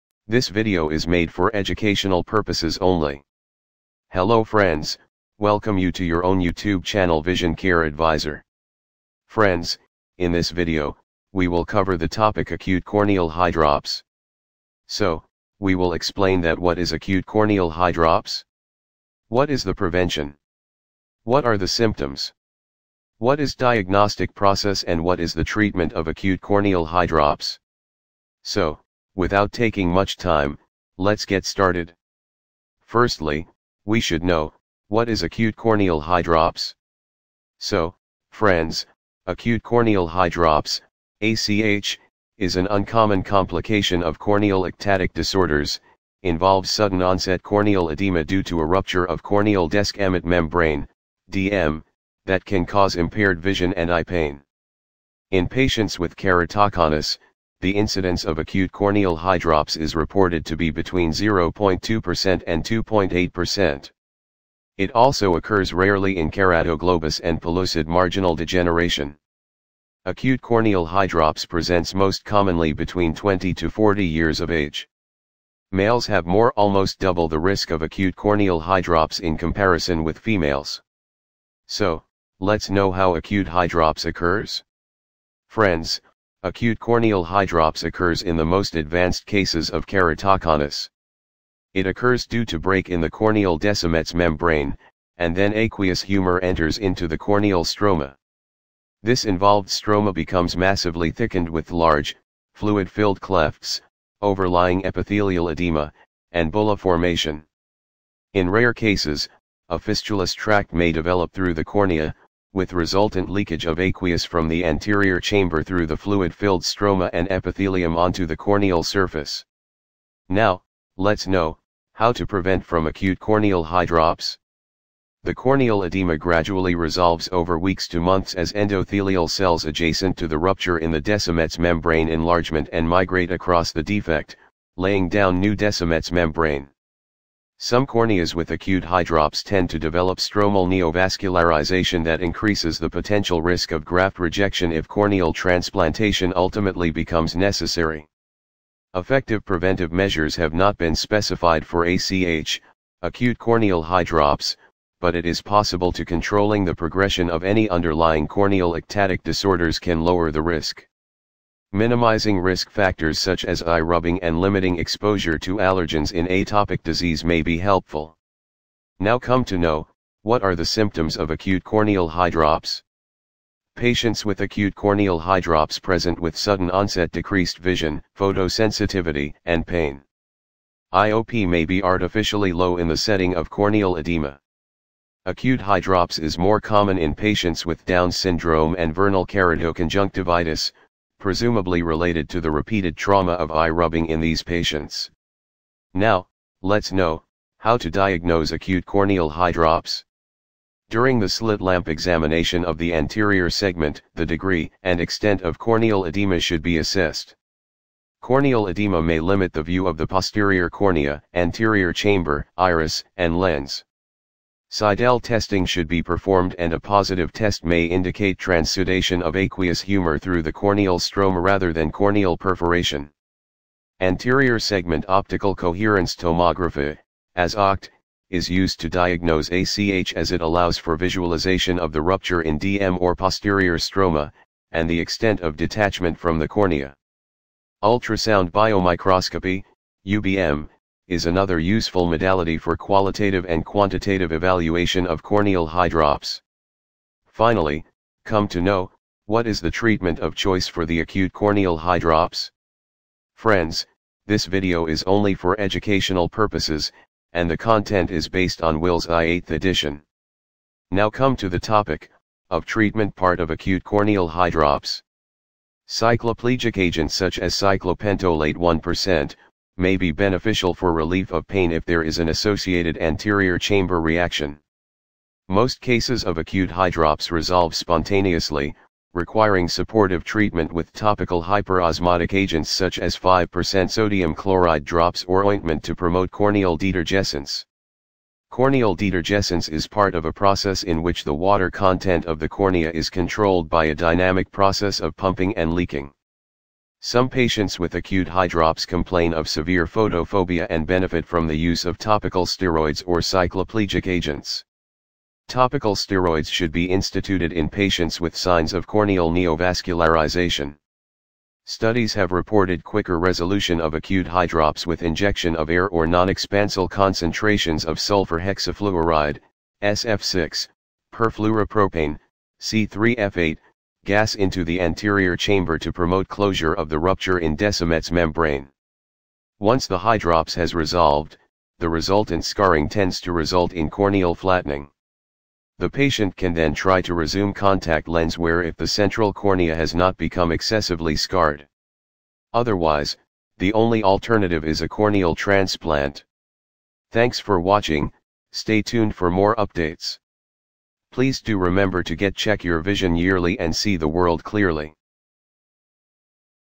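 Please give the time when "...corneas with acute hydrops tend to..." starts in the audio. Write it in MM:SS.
02:17.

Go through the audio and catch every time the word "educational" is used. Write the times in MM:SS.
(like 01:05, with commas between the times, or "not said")
00:01, 04:15.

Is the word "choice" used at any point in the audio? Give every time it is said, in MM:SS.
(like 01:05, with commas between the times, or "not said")
04:10.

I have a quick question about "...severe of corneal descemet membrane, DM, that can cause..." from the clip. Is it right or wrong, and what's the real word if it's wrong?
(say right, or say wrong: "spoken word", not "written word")
wrong: "rupture", not "severe".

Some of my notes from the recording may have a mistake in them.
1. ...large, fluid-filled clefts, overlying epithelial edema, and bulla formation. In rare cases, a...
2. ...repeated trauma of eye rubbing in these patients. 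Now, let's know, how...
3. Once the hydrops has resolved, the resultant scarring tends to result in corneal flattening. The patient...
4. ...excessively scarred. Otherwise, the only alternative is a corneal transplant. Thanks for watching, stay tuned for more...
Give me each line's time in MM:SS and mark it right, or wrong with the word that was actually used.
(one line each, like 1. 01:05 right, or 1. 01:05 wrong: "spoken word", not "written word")
1. 01:41 right
2. 03:12 right
3. 05:29 right
4. 05:40 right.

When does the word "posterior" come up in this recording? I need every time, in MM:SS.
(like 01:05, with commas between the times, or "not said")
03:30, 03:53.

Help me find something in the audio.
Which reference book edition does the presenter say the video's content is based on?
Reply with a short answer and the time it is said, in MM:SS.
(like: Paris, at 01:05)
Wills Eye 8th edition, at 04:18.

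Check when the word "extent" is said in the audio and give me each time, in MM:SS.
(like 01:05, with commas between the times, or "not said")
03:24, 03:55.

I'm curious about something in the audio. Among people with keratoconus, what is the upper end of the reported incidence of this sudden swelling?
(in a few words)
2.8%.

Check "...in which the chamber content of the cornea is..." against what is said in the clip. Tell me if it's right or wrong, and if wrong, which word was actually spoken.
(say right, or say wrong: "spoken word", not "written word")
wrong: "water", not "chamber".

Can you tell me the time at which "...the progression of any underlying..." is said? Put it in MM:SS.
02:36.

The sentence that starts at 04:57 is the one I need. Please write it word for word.
Some patients with acute hydrops complain of severe photophobia and benefit from the use of topical steroids or cycloplegic agents.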